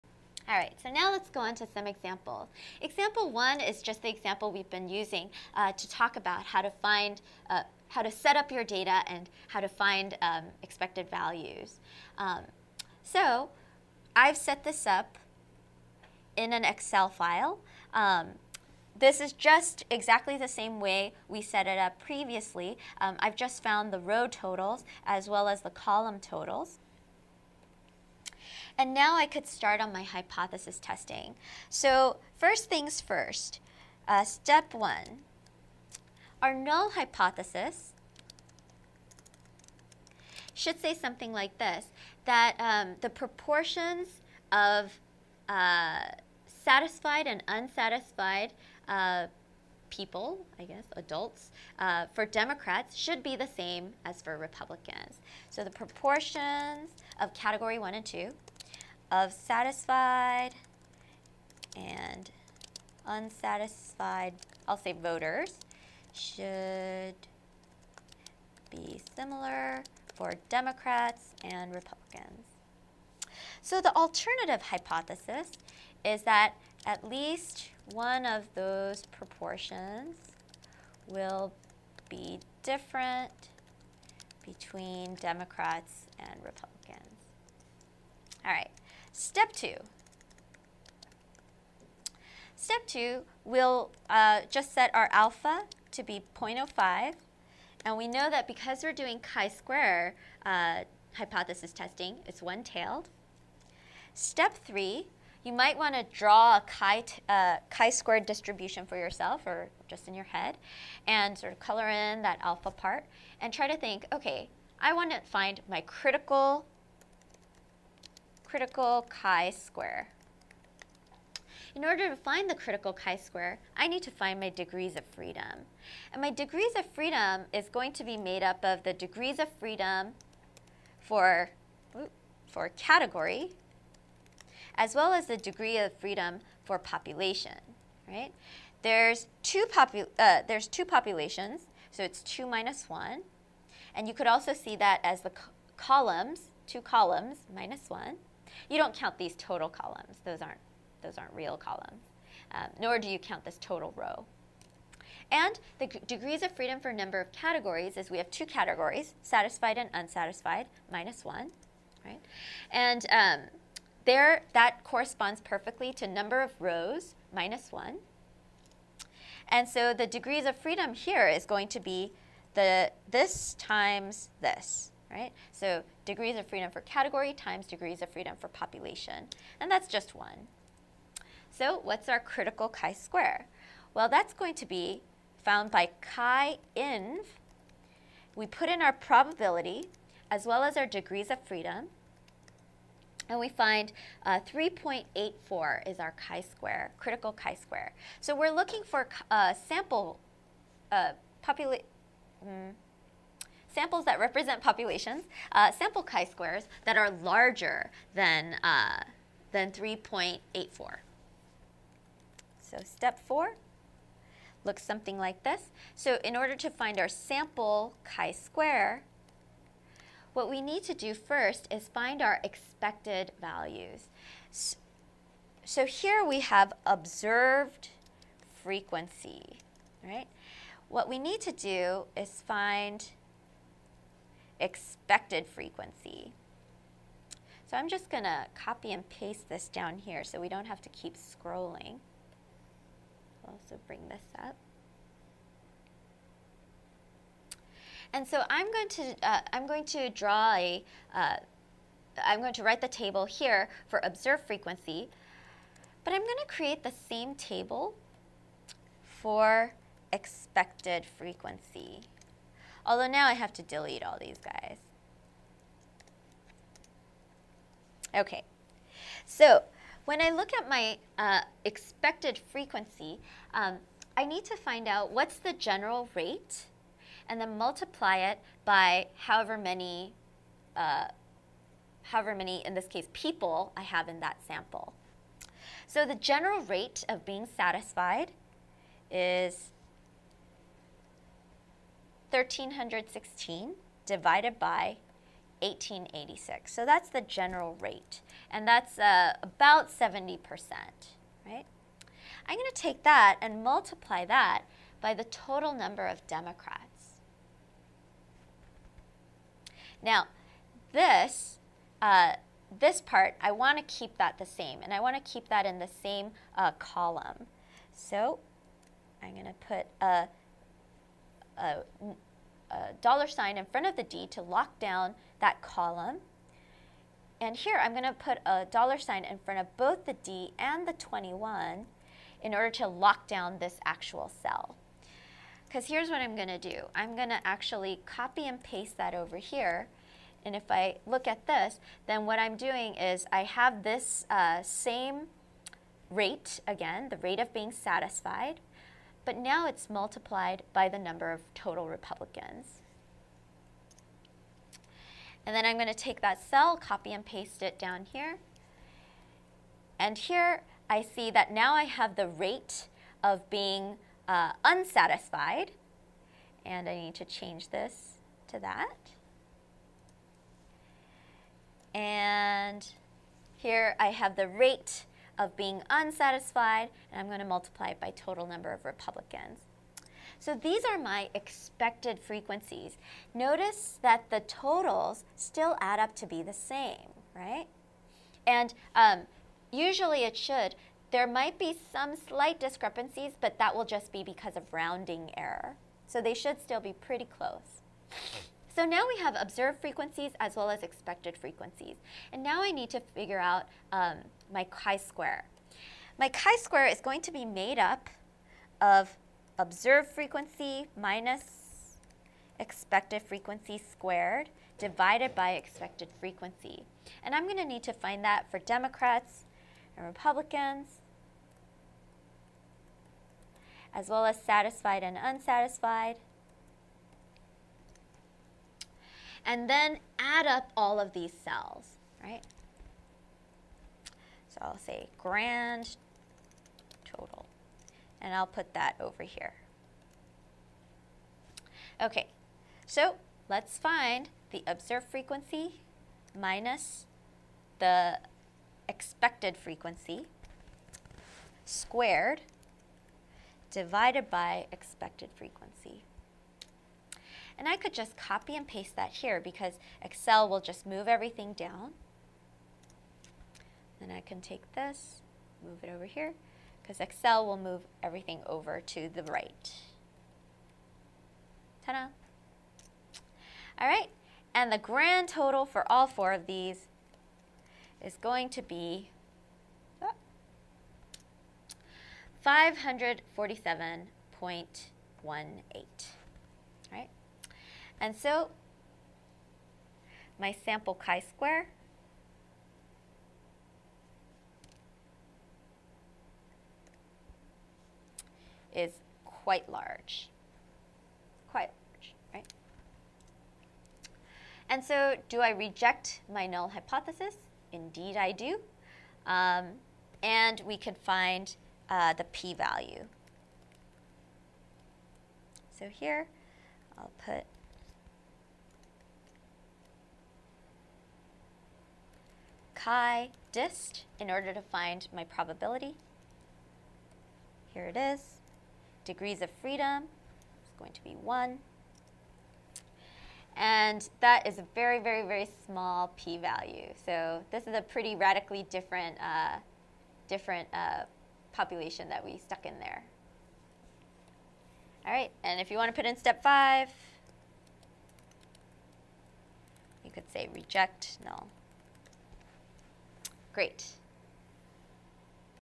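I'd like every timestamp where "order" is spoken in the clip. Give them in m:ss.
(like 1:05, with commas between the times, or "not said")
2:01, 3:36, 5:32, 8:44.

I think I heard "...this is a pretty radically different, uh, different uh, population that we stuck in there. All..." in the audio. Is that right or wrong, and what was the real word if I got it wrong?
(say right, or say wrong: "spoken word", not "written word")
right.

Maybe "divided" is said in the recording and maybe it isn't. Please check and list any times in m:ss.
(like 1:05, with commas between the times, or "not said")
4:54, 6:54, 7:33.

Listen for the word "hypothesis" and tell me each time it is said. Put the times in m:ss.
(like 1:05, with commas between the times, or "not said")
0:30, 0:36, 1:14, 1:41, 8:26.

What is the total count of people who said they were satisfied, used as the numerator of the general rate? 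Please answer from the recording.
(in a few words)
1316.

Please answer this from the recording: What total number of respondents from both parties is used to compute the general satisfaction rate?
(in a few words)
1886.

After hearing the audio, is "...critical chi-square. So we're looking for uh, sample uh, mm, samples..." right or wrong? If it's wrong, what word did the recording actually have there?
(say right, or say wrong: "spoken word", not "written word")
right.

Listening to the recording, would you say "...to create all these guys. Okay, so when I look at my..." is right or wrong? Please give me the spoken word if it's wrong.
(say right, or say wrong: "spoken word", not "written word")
wrong: "delete", not "create".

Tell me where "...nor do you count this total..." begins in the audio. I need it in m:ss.
2:32.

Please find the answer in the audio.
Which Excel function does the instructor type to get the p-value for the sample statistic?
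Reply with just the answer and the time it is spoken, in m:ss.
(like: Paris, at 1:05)
chi dist, at 8:42.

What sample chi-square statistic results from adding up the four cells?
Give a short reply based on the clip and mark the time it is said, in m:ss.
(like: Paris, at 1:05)
547.18, at 8:02.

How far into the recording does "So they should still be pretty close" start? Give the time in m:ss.
6:36.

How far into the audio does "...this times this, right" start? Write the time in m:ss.
2:53.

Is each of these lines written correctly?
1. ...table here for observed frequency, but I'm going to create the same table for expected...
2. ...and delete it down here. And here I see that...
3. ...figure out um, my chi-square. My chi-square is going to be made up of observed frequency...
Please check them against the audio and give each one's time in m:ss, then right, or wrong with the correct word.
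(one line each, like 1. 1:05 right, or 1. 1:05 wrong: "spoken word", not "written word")
1. 4:12 right
2. 5:57 wrong: "paste", not "delete"
3. 6:43 right.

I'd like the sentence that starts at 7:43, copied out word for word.
Then I can take this, move it over here, because Excel will move everything over to the right.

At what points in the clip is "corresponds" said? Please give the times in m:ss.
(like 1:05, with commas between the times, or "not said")
2:44.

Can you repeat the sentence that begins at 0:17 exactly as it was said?
Um, this is just exactly the same way we set it up previously.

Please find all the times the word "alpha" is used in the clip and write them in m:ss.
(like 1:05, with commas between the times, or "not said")
1:35, 1:52.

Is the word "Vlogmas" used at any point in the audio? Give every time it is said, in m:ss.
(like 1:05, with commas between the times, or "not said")
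not said.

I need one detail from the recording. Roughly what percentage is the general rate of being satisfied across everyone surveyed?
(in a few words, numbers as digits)
70%.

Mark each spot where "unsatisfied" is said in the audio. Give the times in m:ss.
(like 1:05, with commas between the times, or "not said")
0:47, 1:03, 2:39, 6:04, 6:15, 7:05.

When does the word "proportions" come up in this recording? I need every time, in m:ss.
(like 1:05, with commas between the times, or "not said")
0:43, 0:55, 1:19.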